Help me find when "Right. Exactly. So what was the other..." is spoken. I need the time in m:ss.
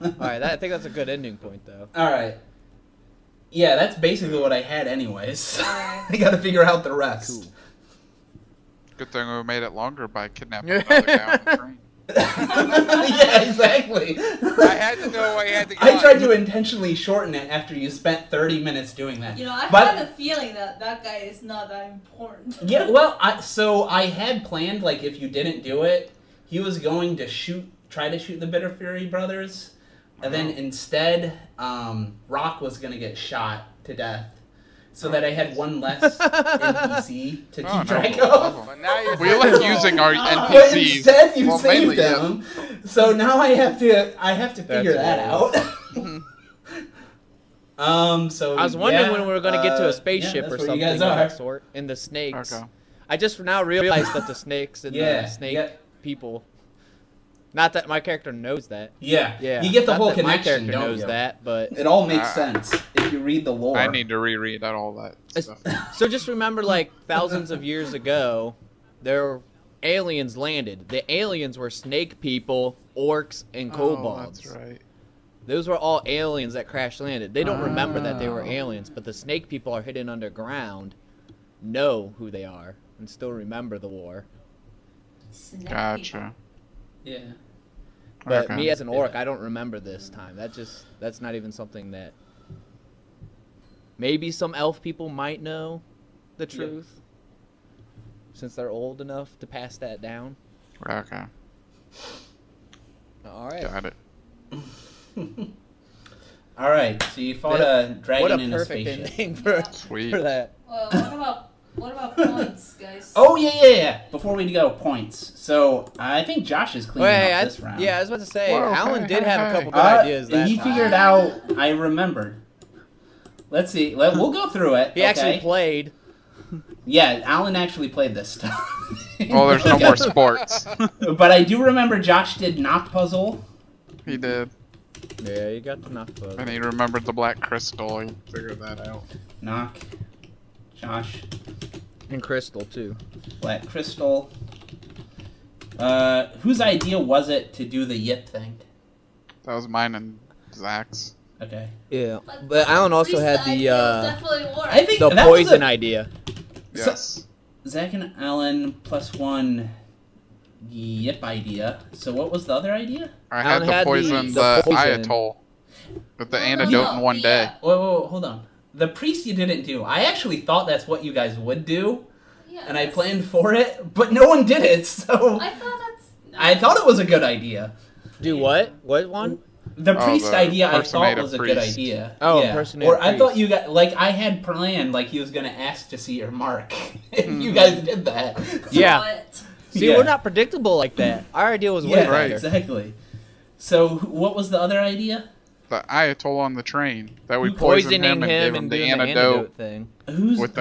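3:12.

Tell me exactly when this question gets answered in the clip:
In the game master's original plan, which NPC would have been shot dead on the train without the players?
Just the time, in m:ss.
0:32.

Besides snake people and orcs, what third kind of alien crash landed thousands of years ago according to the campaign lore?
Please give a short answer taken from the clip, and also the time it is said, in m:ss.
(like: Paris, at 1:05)
Kobolds, at 1:13.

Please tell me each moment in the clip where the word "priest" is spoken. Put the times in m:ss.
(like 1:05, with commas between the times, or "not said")
2:48, 2:59.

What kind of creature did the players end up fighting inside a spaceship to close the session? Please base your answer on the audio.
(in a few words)
A dragon.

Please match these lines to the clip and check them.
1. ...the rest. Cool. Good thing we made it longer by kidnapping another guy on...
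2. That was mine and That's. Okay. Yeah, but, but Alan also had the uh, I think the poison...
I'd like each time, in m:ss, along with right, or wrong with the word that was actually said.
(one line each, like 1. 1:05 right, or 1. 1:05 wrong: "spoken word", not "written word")
1. 0:06 right
2. 2:29 wrong: "Zach", not "That".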